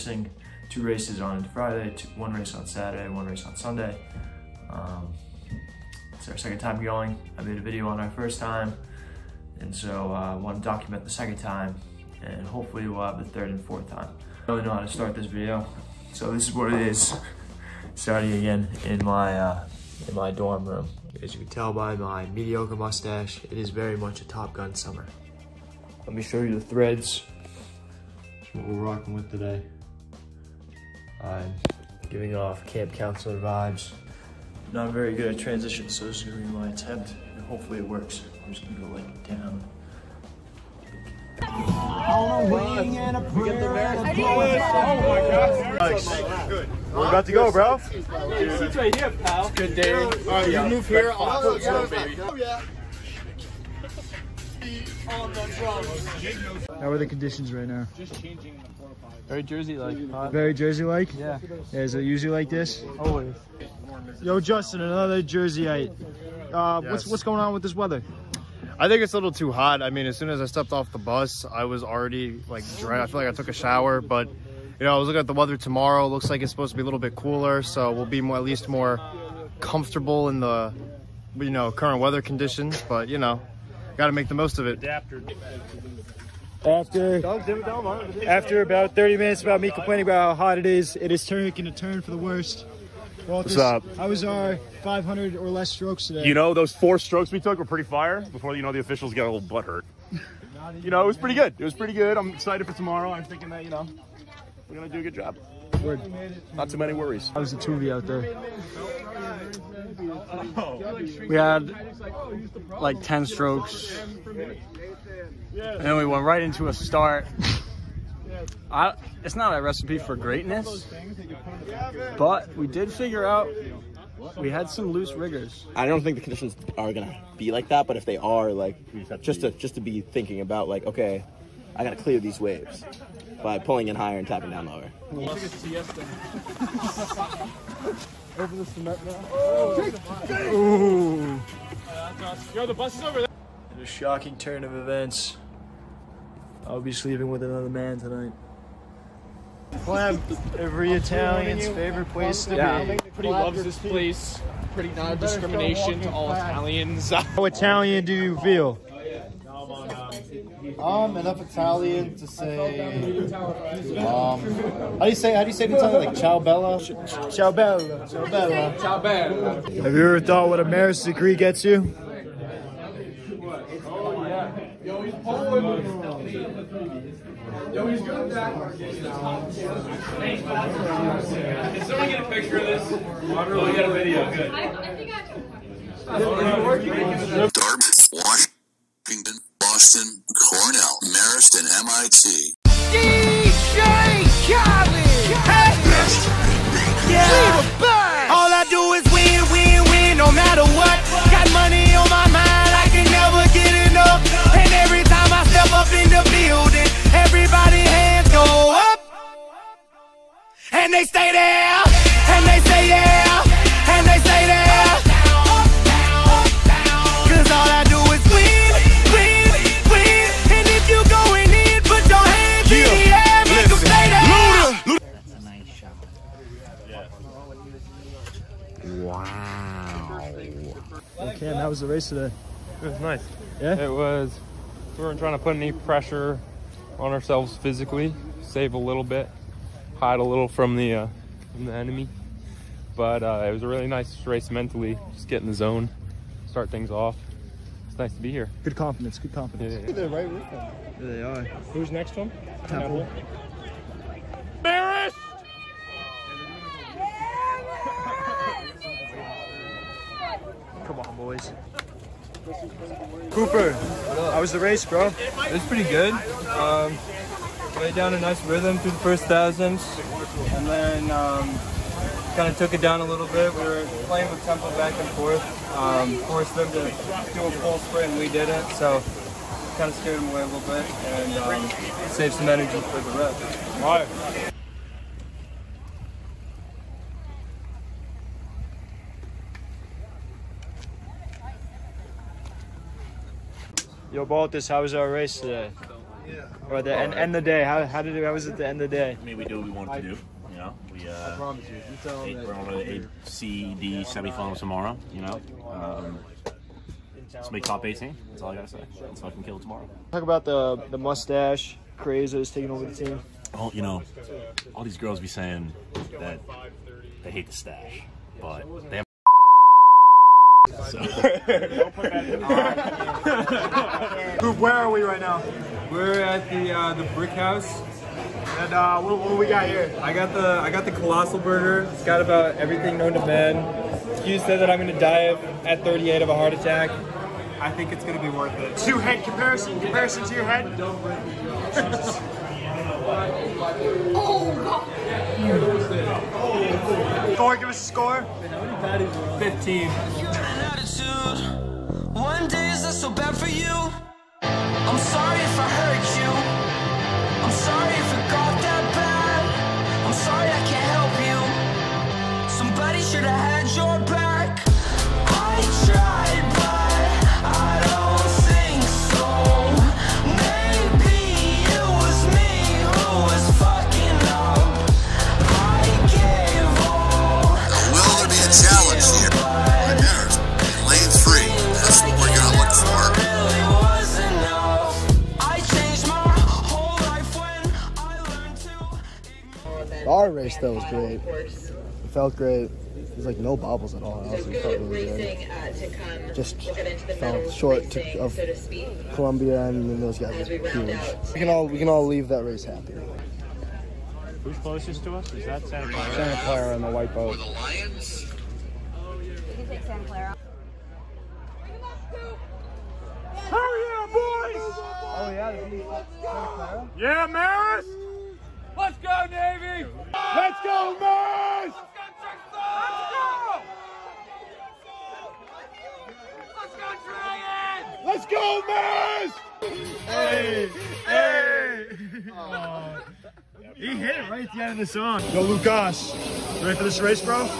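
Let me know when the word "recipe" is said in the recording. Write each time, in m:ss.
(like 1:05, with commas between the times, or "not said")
1:59.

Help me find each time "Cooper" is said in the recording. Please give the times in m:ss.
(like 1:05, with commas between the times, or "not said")
4:23.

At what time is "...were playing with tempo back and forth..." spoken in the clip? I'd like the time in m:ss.
4:33.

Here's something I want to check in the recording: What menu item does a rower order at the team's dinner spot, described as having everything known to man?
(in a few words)
colossal burger.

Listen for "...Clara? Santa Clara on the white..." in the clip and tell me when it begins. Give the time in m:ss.
6:45.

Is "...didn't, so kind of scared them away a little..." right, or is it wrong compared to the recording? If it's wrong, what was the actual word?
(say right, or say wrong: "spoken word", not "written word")
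right.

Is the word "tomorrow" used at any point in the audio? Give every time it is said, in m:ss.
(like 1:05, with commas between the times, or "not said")
1:15, 1:42, 5:04, 5:09.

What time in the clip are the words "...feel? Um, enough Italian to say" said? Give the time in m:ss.
2:38.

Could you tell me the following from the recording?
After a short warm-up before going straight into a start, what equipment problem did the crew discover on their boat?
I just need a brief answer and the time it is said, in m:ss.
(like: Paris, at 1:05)
loose riggers, at 2:04.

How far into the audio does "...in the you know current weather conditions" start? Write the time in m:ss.
1:20.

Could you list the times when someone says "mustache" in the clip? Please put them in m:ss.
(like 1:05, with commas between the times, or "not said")
0:22, 5:10.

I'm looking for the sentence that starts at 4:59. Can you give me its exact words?
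I mean, we do what we wanted to do.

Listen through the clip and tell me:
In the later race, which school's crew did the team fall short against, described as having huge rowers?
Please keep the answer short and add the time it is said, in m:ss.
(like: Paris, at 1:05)
Columbia, at 6:39.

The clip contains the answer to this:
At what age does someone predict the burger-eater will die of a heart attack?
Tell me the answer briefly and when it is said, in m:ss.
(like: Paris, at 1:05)
38, at 5:35.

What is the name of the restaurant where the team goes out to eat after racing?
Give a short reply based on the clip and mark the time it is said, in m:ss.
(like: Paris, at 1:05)
the Brick House, at 5:26.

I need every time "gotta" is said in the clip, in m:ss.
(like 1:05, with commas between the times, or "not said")
2:11, 5:08.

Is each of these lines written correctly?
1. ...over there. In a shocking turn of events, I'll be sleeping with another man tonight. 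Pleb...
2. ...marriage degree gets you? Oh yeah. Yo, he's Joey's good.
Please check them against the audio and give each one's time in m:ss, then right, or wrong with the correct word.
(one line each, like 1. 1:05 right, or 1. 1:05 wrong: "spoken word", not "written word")
1. 2:23 right
2. 2:50 right.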